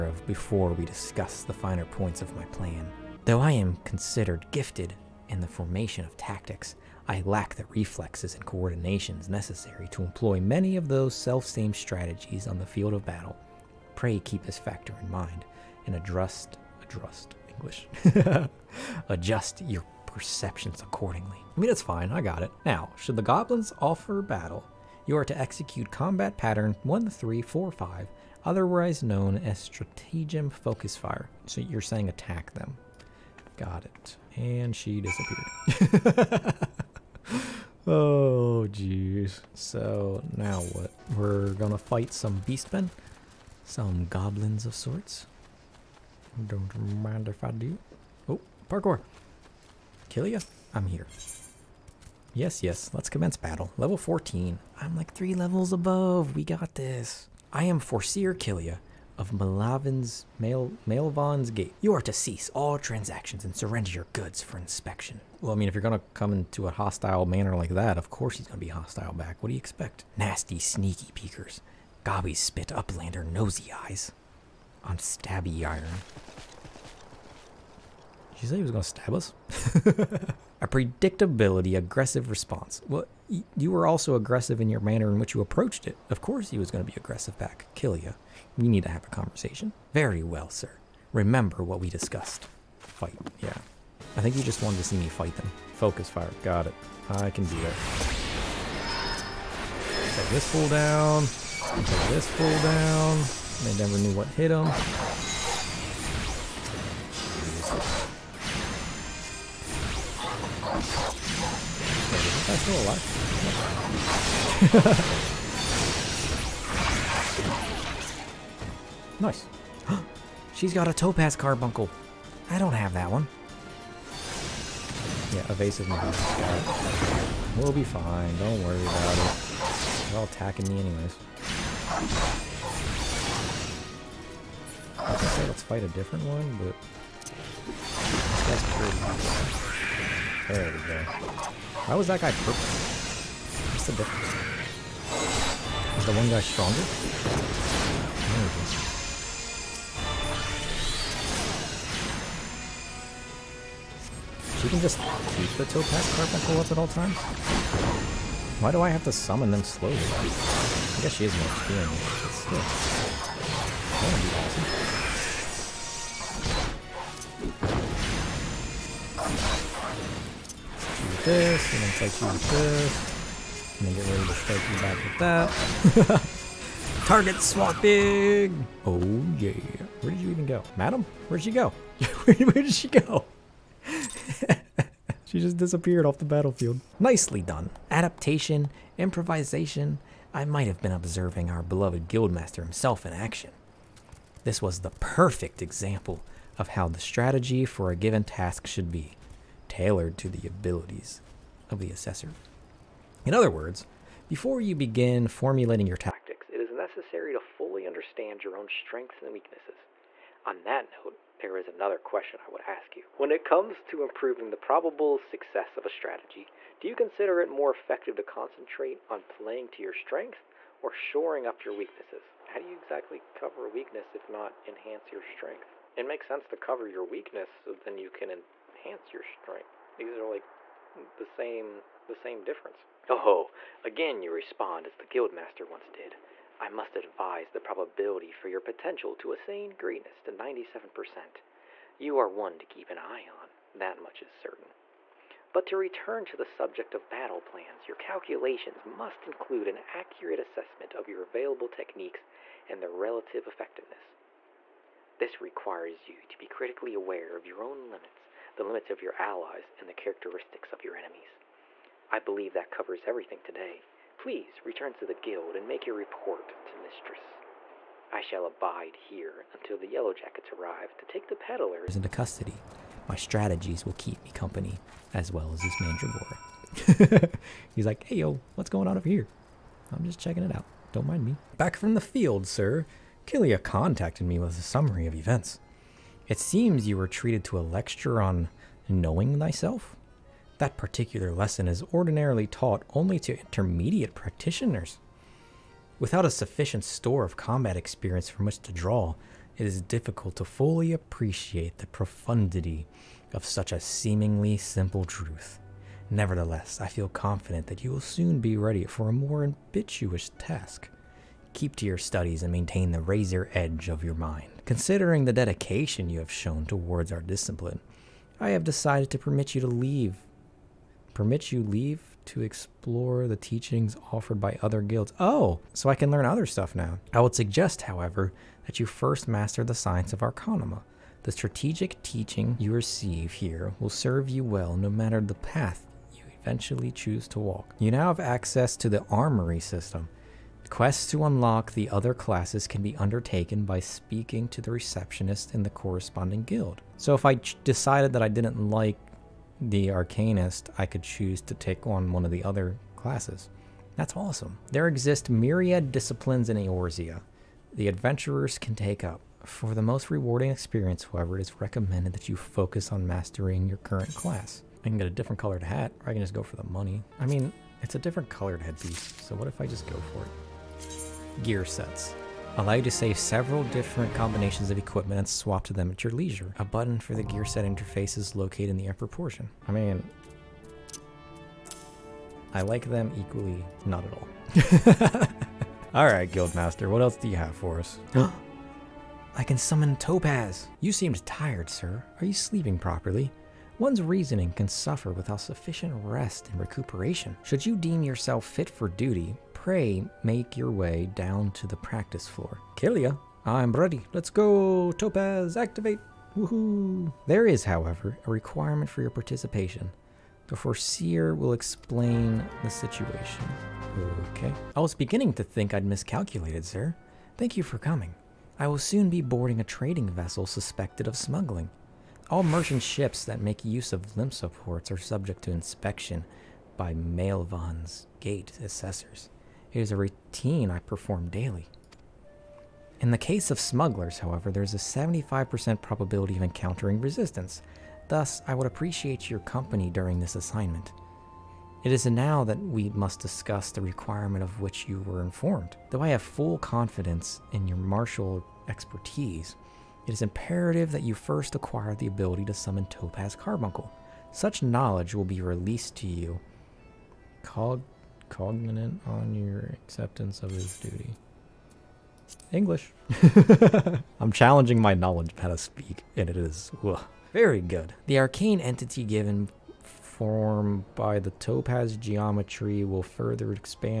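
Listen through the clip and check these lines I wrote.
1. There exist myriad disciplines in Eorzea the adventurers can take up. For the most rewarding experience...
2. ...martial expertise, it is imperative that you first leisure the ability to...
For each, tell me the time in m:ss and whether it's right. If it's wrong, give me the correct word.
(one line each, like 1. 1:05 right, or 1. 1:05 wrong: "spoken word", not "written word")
1. 5:54 right
2. 7:27 wrong: "acquire", not "leisure".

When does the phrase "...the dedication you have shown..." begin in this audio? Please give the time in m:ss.
5:15.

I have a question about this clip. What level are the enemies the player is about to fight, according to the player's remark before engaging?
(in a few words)
14.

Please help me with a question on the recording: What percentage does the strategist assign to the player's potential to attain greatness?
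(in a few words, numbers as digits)
97%.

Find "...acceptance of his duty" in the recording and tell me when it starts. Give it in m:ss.
7:39.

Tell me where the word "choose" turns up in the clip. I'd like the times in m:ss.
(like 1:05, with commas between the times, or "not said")
5:36, 5:51.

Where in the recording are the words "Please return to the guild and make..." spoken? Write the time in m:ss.
4:24.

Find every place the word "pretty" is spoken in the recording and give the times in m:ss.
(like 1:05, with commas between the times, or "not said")
2:18.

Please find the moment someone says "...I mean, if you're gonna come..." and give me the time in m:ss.
1:05.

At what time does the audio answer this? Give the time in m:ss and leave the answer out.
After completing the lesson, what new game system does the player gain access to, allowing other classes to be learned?
5:39.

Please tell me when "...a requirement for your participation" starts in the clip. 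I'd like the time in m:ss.
6:48.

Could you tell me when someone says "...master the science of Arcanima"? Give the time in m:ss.
5:29.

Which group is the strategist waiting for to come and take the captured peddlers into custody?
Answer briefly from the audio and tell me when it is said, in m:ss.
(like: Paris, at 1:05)
Yellow Jackets, at 4:29.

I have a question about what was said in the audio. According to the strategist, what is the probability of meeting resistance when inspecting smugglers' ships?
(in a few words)
75%.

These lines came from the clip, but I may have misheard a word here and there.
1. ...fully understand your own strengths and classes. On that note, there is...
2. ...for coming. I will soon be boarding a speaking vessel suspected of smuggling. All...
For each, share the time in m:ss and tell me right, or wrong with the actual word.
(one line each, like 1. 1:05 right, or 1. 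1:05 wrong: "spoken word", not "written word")
1. 3:27 wrong: "weaknesses", not "classes"
2. 6:57 wrong: "trading", not "speaking".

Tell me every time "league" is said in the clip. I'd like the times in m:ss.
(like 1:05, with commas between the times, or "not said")
not said.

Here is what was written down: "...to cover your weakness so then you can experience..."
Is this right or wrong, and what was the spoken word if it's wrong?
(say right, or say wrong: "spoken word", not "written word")
wrong: "enhance", not "experience".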